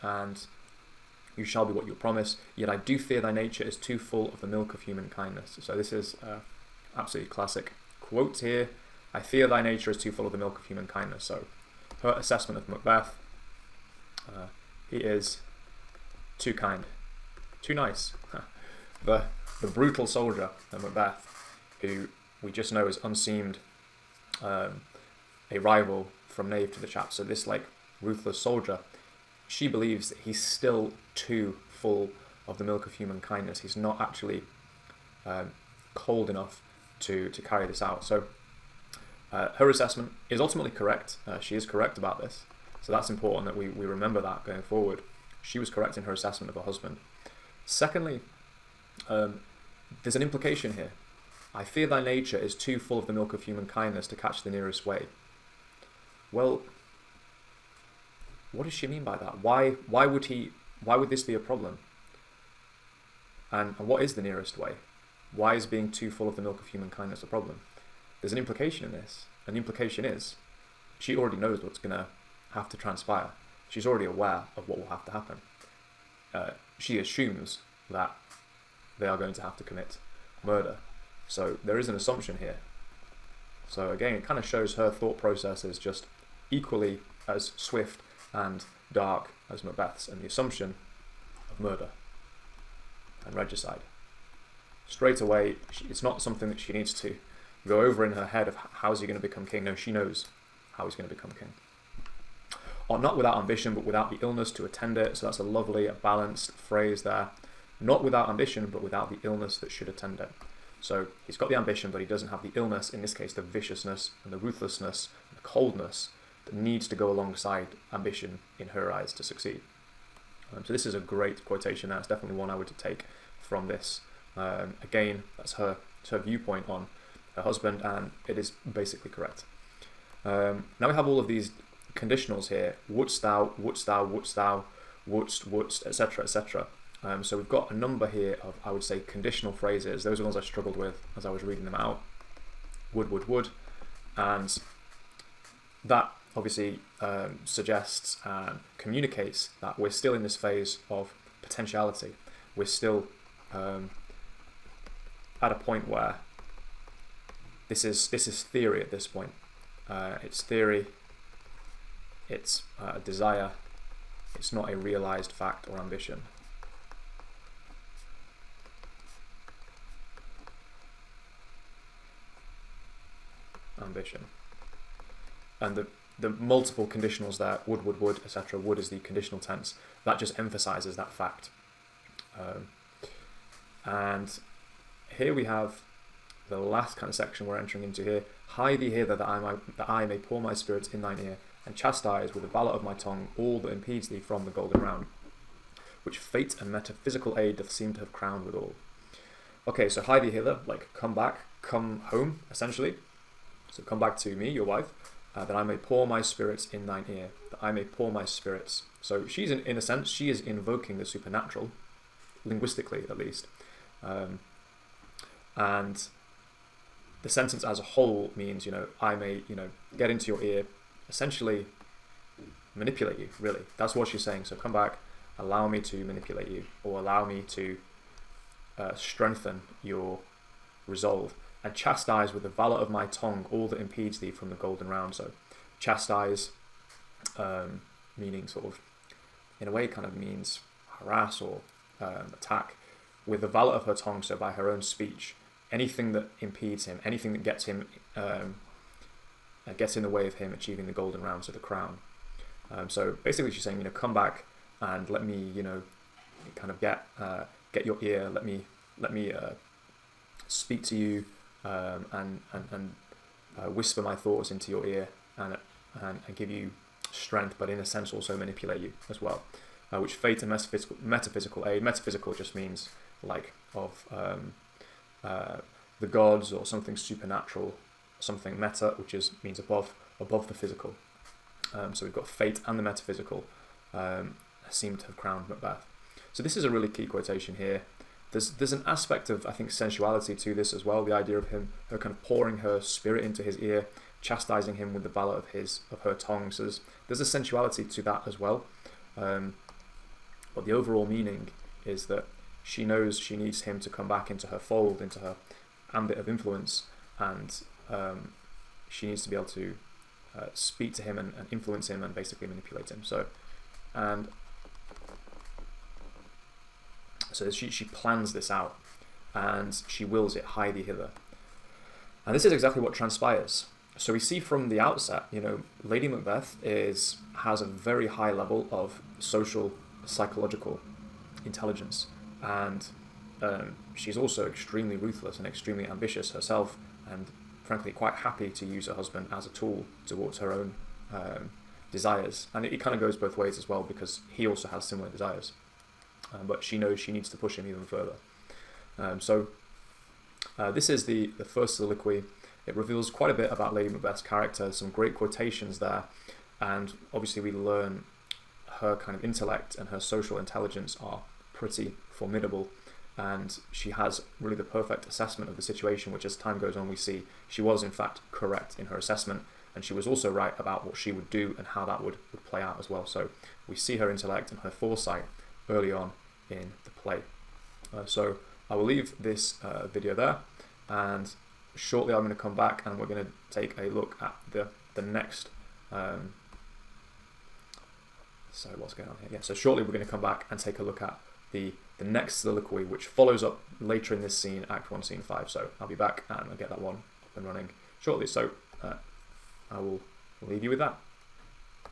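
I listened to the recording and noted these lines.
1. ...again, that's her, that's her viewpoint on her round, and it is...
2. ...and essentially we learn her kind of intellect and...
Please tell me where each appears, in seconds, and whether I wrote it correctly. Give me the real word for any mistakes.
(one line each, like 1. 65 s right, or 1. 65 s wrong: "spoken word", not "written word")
1. 124 s wrong: "husband", not "round"
2. 356 s wrong: "obviously", not "essentially".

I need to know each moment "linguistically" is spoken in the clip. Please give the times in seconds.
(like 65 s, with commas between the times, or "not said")
212 s.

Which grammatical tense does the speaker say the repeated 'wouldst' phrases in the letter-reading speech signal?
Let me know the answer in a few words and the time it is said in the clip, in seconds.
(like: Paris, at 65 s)
conditional tense, at 178 s.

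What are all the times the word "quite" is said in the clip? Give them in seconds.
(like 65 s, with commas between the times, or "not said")
337 s, 353 s.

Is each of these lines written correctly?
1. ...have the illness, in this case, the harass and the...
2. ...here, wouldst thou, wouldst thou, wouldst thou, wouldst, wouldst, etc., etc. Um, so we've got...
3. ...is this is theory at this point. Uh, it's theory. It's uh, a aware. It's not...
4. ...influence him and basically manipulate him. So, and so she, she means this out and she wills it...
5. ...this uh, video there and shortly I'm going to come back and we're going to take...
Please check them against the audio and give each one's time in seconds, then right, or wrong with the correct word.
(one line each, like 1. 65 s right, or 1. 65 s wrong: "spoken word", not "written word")
1. 112 s wrong: "viciousness", not "harass"
2. 132 s right
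3. 157 s wrong: "desire", not "aware"
4. 311 s wrong: "plans", not "means"
5. 379 s right.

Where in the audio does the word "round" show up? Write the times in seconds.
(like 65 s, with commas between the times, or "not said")
194 s, 234 s, 251 s.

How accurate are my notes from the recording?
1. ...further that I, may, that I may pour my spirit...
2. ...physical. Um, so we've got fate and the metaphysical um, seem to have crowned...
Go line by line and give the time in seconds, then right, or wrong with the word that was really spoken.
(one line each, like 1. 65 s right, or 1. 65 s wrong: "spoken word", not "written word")
1. 188 s wrong: "hither", not "further"
2. 280 s right.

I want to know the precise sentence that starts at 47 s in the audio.
Secondly, um, there's an implication here.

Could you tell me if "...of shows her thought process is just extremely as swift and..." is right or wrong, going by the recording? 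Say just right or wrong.
wrong.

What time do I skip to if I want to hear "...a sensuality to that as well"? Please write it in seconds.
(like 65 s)
297 s.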